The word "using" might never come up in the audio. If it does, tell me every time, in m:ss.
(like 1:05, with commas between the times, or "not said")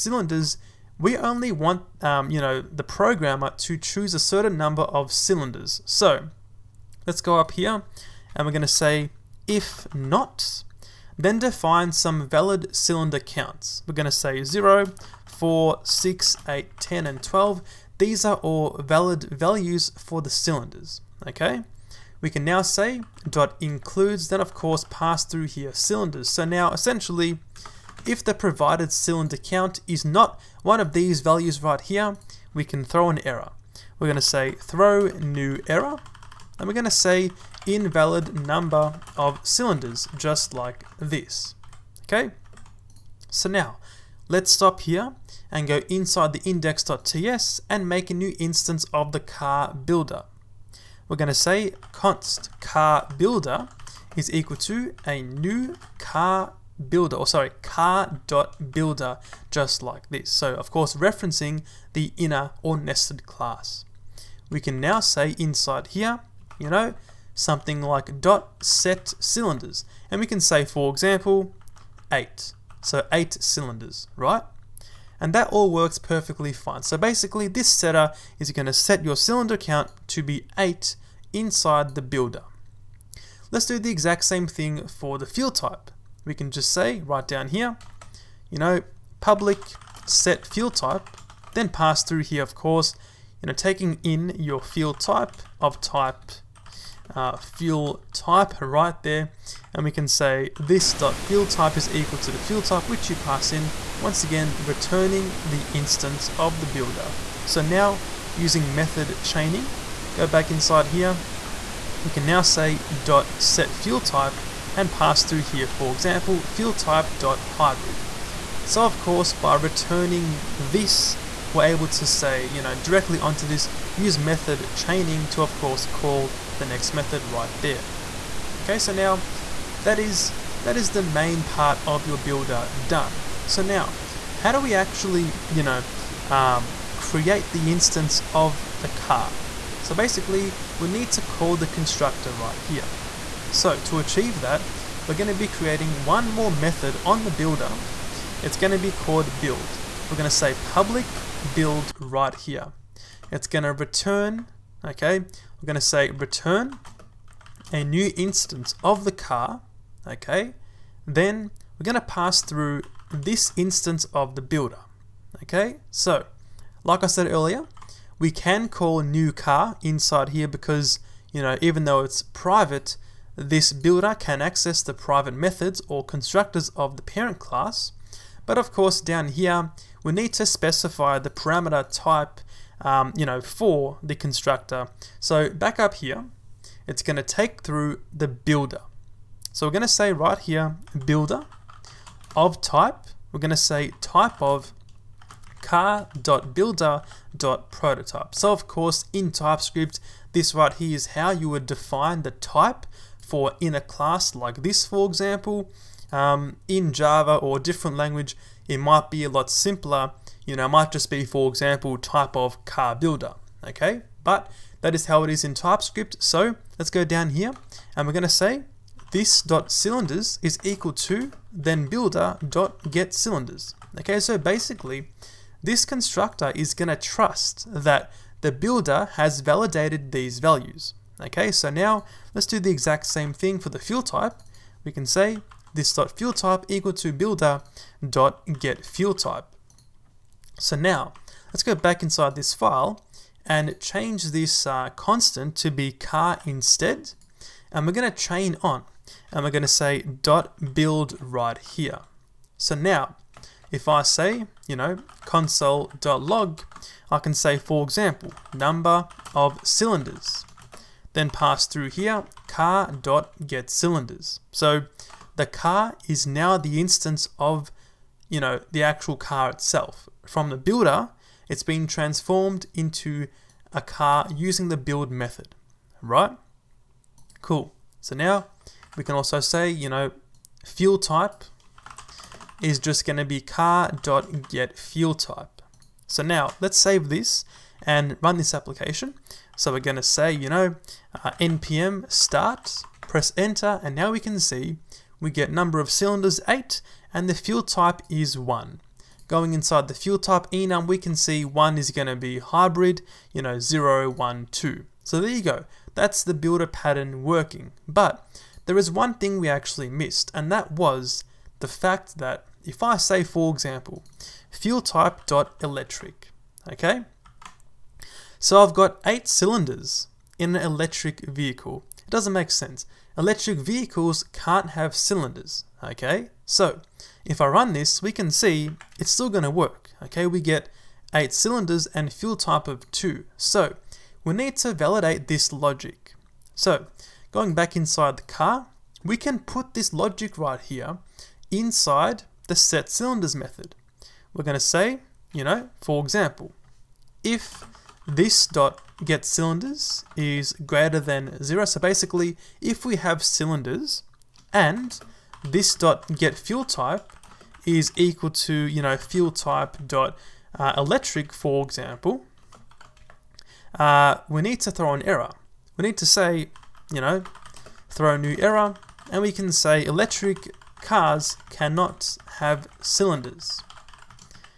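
1:48, 4:34.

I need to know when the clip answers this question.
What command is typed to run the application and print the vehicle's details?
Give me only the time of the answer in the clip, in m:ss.
4:51.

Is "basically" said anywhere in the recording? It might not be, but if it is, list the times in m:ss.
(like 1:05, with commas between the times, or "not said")
1:16, 2:19, 3:44, 5:51.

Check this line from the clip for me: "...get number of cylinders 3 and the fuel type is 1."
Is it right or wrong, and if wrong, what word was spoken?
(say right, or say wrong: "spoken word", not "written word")
wrong: "8", not "3".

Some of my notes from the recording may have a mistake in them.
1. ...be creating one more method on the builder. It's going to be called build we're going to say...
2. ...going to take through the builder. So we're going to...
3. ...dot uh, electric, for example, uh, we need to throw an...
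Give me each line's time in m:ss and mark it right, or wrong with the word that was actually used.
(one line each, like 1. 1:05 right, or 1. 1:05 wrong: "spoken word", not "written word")
1. 2:25 right
2. 3:07 right
3. 5:59 right.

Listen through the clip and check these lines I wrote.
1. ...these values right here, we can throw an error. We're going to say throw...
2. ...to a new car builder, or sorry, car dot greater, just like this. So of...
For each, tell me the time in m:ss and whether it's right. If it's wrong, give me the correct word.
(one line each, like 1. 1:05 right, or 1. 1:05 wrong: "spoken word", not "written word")
1. 0:30 right
2. 0:54 wrong: "builder", not "greater".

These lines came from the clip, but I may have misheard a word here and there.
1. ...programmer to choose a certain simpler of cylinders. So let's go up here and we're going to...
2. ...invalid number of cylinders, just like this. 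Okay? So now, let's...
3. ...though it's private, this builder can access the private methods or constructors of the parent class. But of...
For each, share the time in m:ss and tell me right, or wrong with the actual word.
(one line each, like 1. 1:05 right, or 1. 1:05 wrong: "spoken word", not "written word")
1. 0:02 wrong: "number", not "simpler"
2. 0:37 right
3. 2:51 right.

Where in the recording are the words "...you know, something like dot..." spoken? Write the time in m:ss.
1:06.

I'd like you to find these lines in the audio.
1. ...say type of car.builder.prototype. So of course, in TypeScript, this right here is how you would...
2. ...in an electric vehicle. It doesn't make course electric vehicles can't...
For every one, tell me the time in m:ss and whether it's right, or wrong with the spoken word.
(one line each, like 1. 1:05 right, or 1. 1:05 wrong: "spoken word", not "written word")
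1. 3:13 right
2. 5:20 wrong: "sense", not "course".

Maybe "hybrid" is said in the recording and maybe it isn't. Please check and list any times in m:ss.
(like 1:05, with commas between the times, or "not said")
1:57, 5:02.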